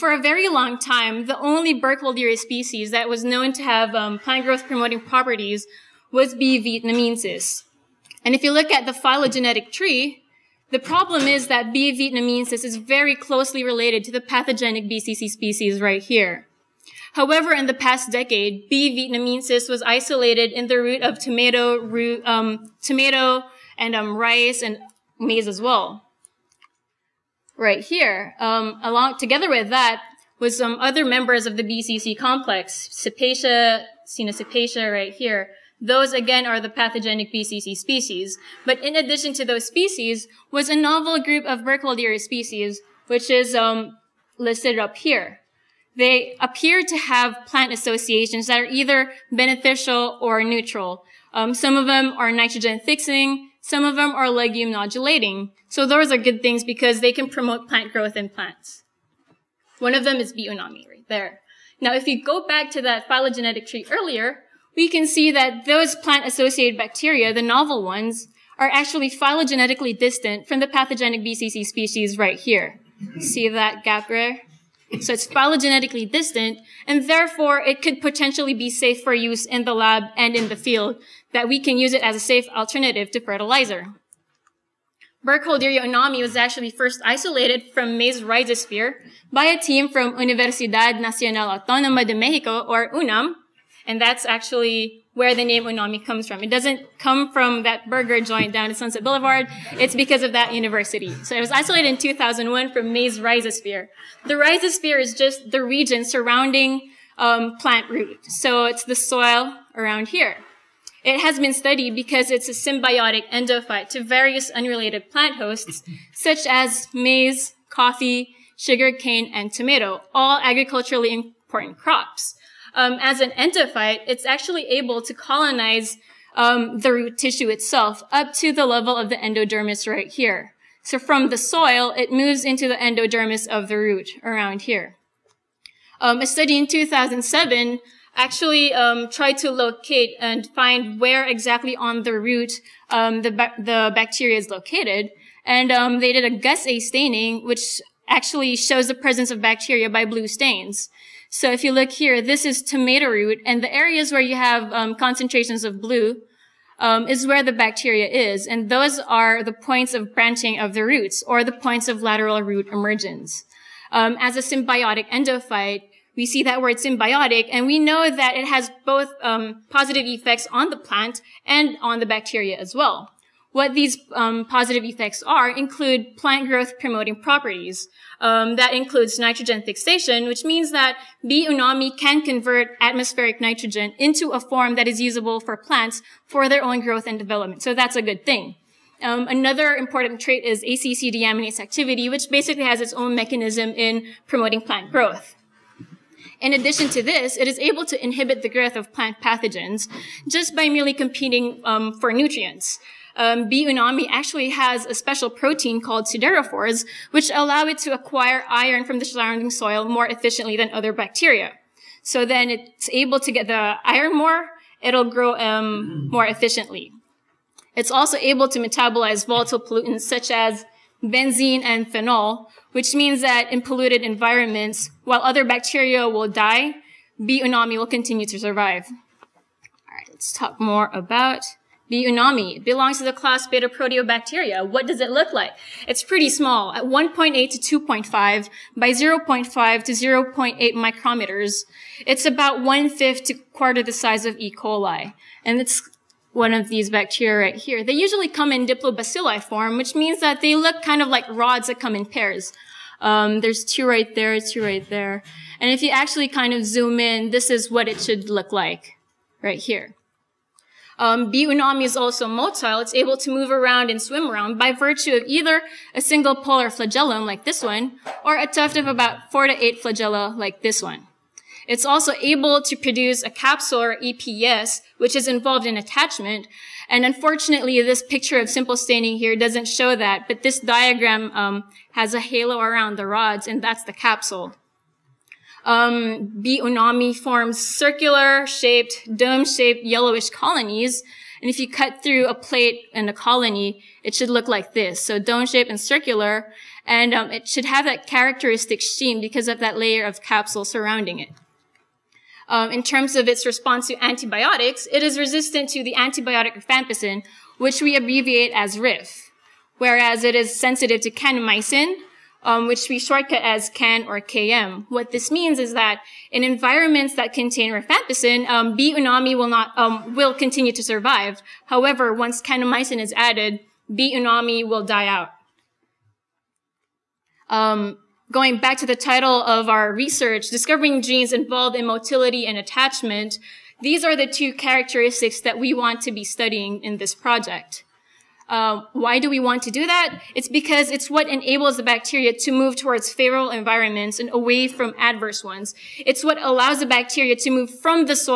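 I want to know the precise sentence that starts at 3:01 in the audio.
unami can convert atmospheric nitrogen into a form that is usable for plants for their own growth and development.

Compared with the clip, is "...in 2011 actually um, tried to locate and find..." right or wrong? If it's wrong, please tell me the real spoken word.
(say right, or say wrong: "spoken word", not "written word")
wrong: "2007", not "2011".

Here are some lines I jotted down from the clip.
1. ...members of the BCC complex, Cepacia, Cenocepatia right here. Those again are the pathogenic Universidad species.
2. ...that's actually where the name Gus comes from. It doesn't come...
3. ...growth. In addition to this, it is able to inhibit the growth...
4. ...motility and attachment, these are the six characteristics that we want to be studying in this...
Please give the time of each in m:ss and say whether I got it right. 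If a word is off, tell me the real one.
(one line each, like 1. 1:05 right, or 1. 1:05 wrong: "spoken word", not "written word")
1. 0:31 wrong: "BCC", not "Universidad"
2. 1:34 wrong: "Unami", not "Gus"
3. 3:14 right
4. 5:31 wrong: "two", not "six".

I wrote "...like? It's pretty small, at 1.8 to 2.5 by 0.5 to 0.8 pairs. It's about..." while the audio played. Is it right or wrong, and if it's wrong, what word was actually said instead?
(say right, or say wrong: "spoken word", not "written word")
wrong: "micrometers", not "pairs".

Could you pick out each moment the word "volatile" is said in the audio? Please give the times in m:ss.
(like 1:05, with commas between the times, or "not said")
3:39.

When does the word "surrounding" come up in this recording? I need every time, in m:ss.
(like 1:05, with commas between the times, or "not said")
1:46, 3:29, 5:00.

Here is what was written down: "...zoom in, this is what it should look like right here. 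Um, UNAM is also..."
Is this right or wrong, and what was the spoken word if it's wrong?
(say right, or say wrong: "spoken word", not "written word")
wrong: "Biunami", not "UNAM".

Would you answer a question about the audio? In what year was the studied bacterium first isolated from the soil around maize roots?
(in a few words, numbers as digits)
2001.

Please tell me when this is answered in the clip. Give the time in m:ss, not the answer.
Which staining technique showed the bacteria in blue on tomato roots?
2:26.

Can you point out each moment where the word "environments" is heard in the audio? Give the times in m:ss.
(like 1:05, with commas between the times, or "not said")
3:44, 5:16, 5:43.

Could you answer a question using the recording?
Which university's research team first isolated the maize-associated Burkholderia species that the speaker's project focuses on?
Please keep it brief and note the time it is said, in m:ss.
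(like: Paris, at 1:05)
Universidad Nacional Autónoma de Mexico, at 1:30.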